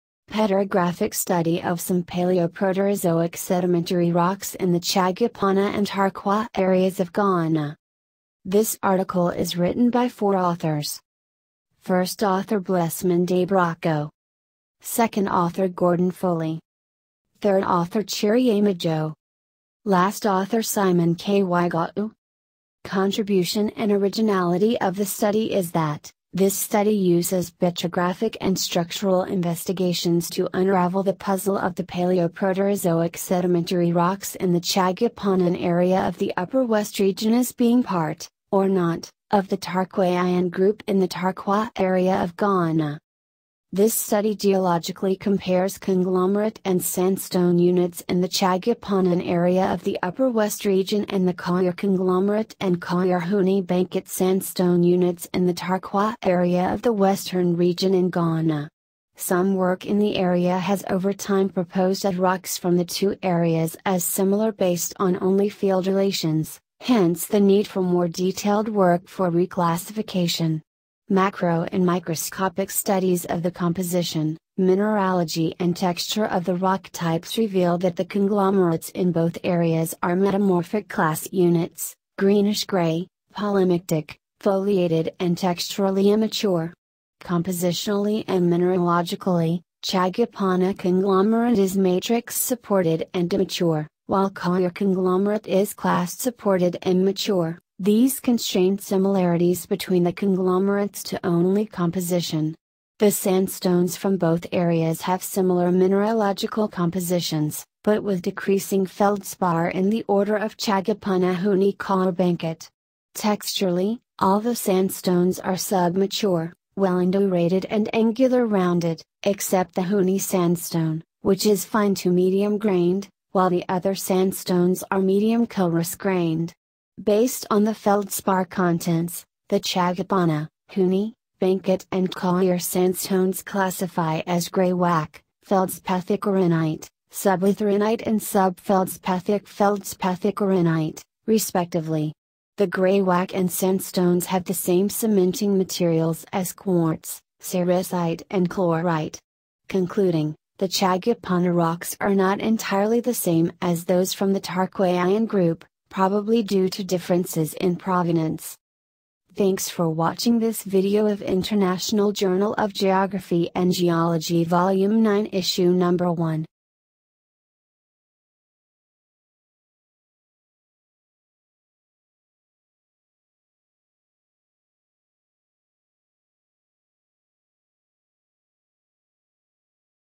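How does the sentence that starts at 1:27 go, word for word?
Compositionally and mineralogically, Chagupana conglomerate is matrix supported and immature, while Kawere conglomerate is clast supported and mature.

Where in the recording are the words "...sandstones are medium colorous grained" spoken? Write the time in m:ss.
2:03.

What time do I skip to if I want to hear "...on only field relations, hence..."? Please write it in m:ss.
1:04.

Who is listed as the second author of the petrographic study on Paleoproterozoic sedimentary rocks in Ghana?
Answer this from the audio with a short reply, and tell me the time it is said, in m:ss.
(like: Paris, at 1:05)
Gordon Foley, at 0:15.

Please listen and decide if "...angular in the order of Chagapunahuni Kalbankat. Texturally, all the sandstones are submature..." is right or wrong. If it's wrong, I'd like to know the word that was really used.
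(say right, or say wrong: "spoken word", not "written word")
wrong: "feldspar", not "angular".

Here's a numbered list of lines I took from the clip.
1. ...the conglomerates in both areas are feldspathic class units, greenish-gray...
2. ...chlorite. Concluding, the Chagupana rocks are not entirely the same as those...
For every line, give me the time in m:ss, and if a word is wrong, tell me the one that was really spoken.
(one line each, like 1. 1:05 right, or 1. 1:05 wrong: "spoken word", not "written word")
1. 1:17 wrong: "metamorphic", not "feldspathic"
2. 2:28 right.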